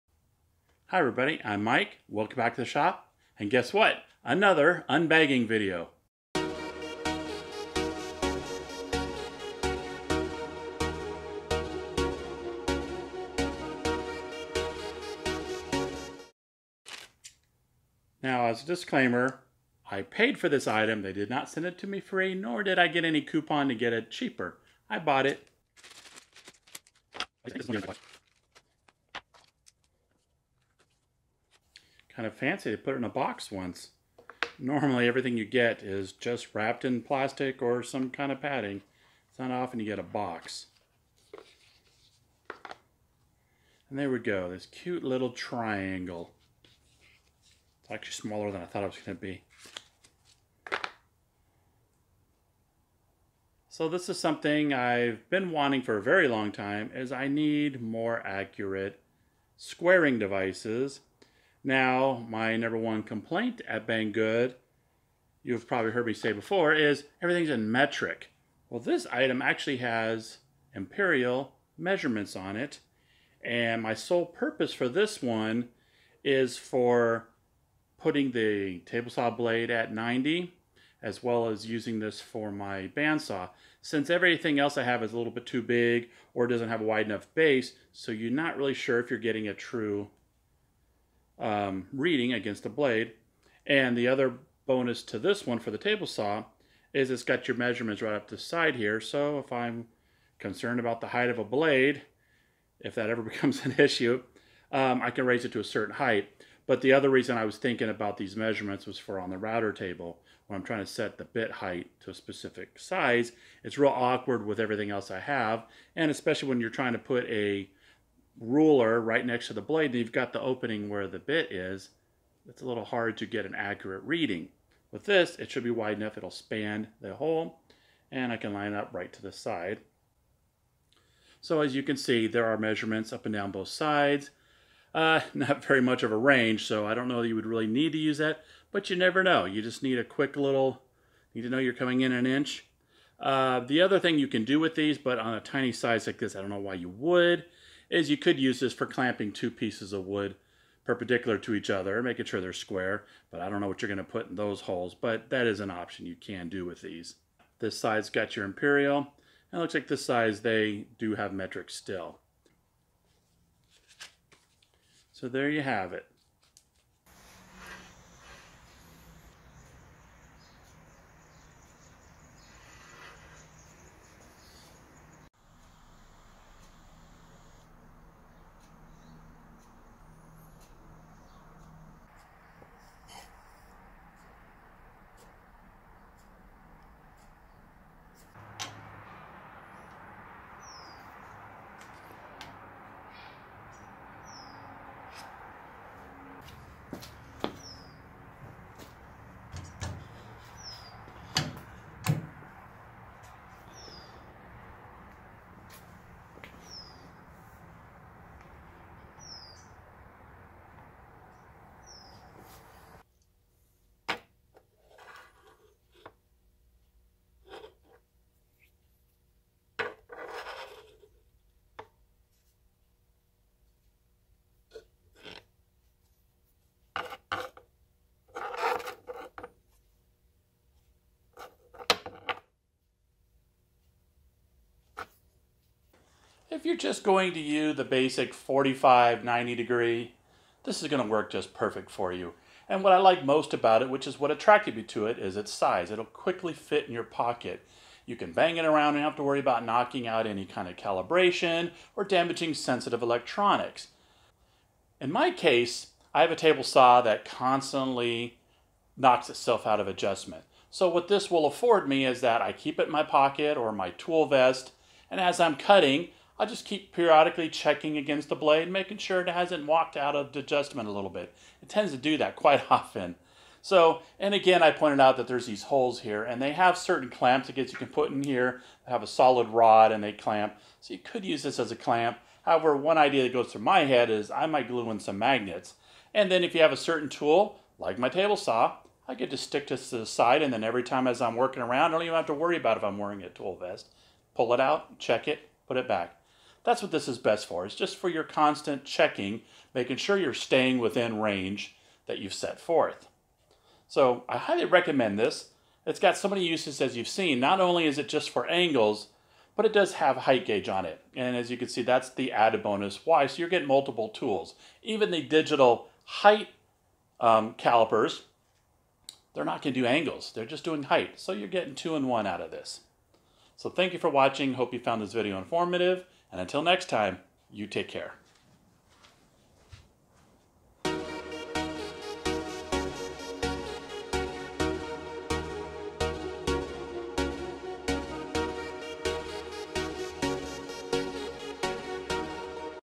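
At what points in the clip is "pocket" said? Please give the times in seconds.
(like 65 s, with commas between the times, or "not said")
247 s, 263 s.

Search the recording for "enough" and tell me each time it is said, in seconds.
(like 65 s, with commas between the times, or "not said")
87 s, 125 s.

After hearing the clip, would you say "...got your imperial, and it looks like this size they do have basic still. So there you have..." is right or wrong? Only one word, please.
wrong.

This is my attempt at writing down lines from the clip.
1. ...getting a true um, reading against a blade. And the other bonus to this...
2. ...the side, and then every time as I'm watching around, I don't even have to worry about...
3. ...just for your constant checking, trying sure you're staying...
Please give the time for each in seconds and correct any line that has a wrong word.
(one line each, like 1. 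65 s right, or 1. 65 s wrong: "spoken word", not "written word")
1. 89 s right
2. 289 s wrong: "working", not "watching"
3. 297 s wrong: "making", not "trying".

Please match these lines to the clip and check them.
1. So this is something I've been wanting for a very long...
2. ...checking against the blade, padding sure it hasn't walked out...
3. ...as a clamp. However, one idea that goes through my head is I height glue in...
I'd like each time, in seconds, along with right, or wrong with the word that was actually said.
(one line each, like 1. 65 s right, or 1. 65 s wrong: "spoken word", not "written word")
1. 53 s right
2. 267 s wrong: "making", not "padding"
3. 281 s wrong: "might", not "height".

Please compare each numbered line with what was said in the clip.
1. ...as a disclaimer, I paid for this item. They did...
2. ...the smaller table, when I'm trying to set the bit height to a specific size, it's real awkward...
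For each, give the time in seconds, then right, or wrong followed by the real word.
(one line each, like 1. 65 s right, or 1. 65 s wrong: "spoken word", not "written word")
1. 18 s right
2. 109 s wrong: "router", not "smaller".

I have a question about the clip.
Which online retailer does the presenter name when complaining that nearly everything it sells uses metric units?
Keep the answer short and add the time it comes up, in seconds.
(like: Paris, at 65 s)
Banggood, at 63 s.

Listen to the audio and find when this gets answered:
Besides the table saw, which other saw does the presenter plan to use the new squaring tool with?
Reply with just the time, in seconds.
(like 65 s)
82 s.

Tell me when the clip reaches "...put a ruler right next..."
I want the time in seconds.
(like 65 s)
116 s.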